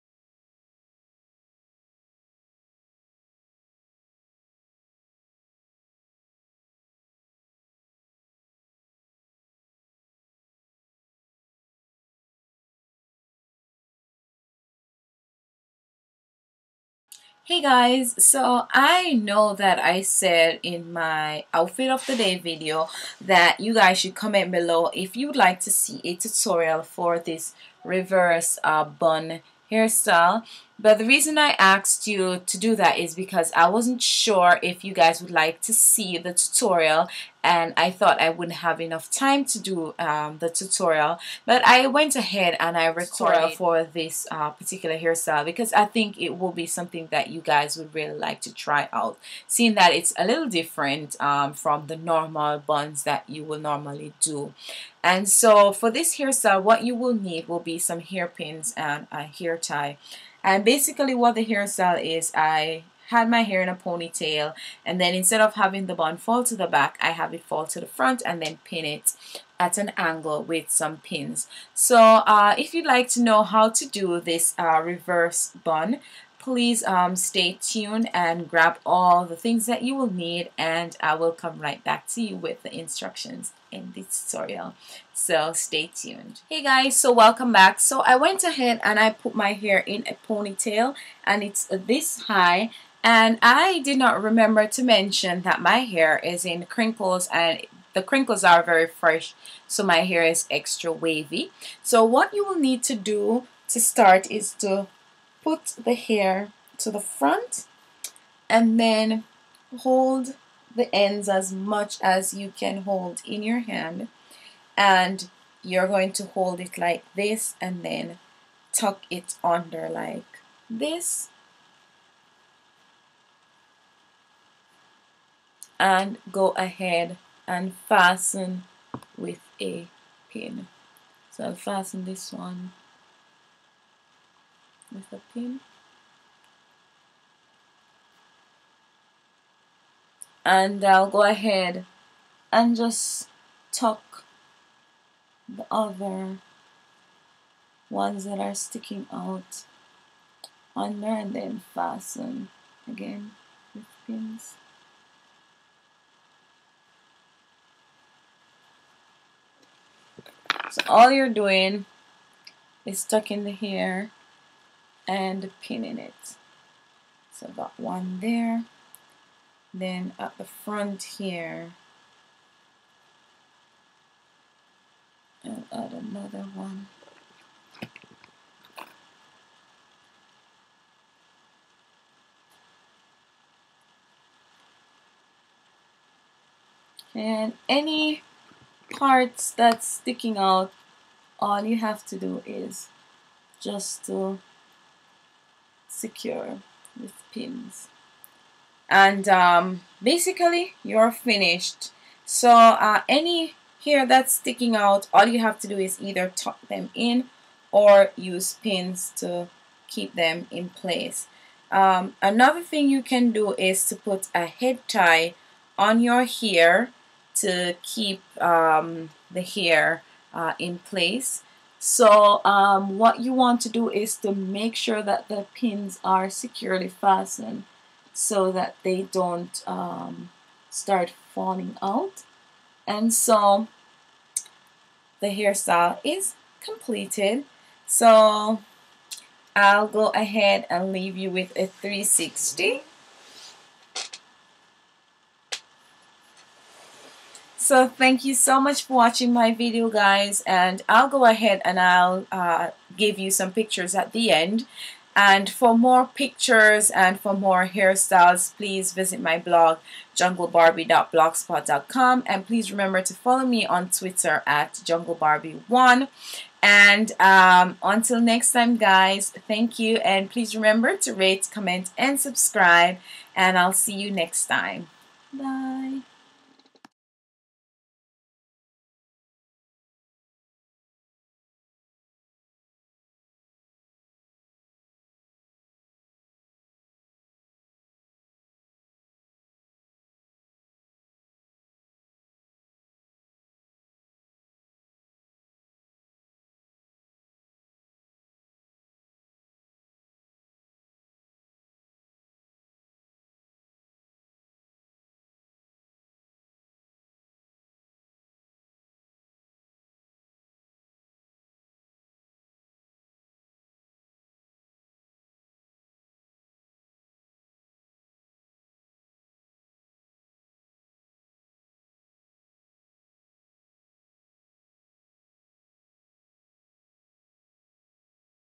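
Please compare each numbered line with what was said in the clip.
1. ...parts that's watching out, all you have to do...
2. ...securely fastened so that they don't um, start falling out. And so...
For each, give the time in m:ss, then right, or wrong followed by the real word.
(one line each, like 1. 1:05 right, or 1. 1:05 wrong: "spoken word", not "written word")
1. 3:08 wrong: "sticking", not "watching"
2. 3:46 right.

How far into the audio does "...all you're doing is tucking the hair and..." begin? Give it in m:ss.
2:40.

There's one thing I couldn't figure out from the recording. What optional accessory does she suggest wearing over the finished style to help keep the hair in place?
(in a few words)
A head tie.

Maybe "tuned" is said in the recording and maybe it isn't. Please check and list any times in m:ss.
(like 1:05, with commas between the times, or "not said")
1:17, 1:25.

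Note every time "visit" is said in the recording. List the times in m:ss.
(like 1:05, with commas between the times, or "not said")
4:18.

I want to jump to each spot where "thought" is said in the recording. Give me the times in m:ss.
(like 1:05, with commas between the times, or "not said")
0:37.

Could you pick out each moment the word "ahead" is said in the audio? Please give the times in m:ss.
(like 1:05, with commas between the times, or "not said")
0:42, 1:28, 2:06, 2:21, 4:00, 4:11.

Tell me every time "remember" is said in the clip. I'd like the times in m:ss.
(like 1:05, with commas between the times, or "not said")
1:34, 4:22, 4:30.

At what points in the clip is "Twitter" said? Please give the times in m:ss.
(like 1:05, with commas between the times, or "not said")
4:23.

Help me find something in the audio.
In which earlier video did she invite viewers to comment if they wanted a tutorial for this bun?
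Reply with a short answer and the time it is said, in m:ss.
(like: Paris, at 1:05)
Outfit of the day video, at 0:21.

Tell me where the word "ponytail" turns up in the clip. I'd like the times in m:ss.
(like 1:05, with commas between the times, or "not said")
1:03, 1:30.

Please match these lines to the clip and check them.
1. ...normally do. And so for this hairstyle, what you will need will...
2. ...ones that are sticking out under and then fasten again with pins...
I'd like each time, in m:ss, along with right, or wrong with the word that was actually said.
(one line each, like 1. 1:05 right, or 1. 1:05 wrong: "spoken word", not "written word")
1. 0:53 right
2. 2:27 right.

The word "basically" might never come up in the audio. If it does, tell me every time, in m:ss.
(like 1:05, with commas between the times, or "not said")
1:00, 3:20.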